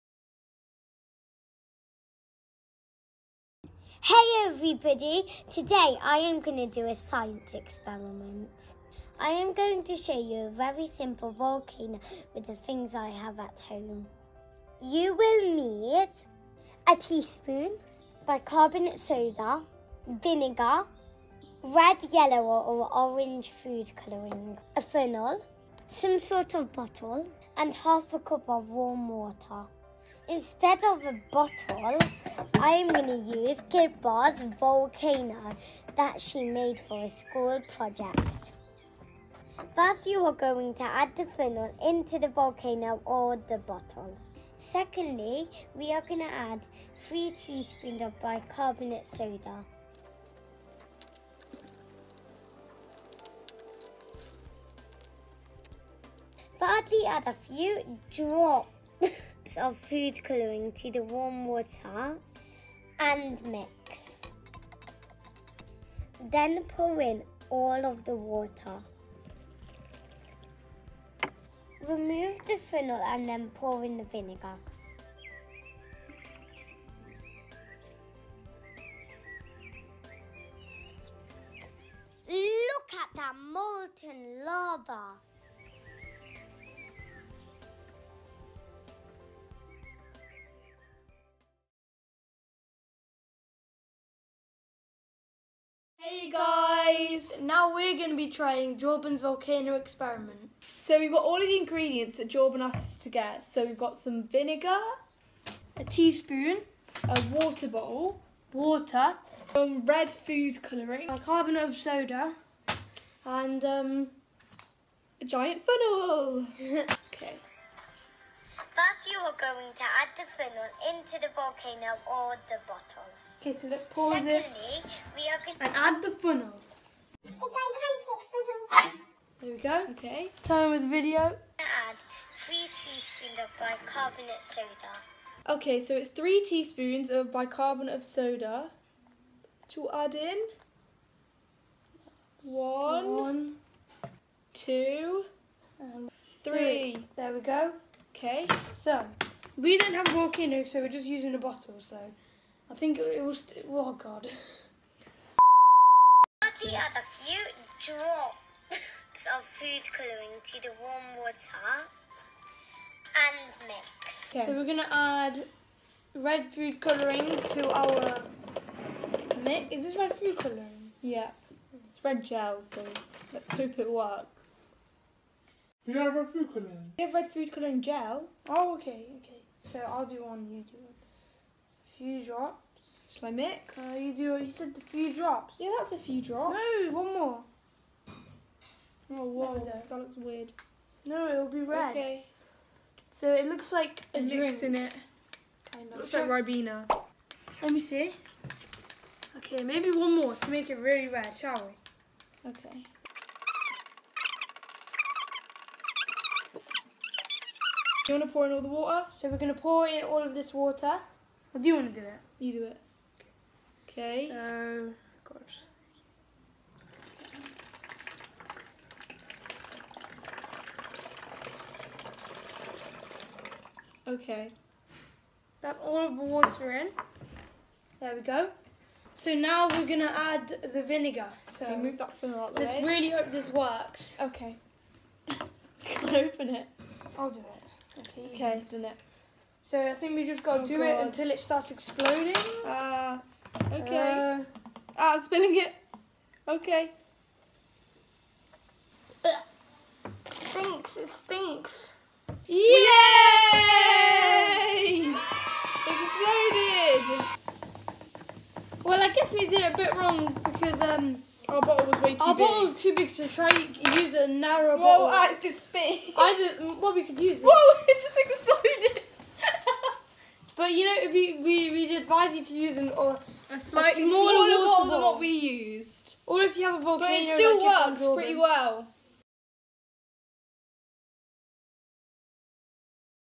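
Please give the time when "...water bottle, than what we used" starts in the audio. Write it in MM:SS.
04:34.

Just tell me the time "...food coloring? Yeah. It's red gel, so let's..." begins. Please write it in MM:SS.
02:50.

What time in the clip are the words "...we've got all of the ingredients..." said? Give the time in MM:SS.
01:40.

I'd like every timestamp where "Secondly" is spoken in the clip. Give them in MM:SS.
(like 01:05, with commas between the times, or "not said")
00:44, 02:04.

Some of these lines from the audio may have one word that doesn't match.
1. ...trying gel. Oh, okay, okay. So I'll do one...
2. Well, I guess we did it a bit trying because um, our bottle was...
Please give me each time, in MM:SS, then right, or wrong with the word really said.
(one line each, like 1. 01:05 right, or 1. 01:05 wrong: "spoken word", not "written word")
1. 02:57 wrong: "coloring", not "trying"
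2. 04:18 wrong: "wrong", not "trying".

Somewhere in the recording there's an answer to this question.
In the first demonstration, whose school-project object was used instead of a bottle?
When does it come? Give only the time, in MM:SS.
00:33.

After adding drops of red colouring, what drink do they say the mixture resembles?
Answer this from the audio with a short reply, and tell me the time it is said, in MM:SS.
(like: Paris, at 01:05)
Ribena, at 03:16.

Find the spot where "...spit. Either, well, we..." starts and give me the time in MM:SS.
04:25.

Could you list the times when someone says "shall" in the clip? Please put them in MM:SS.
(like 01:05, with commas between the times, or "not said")
03:03, 03:21.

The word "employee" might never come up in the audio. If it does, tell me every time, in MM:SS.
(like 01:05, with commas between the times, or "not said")
not said.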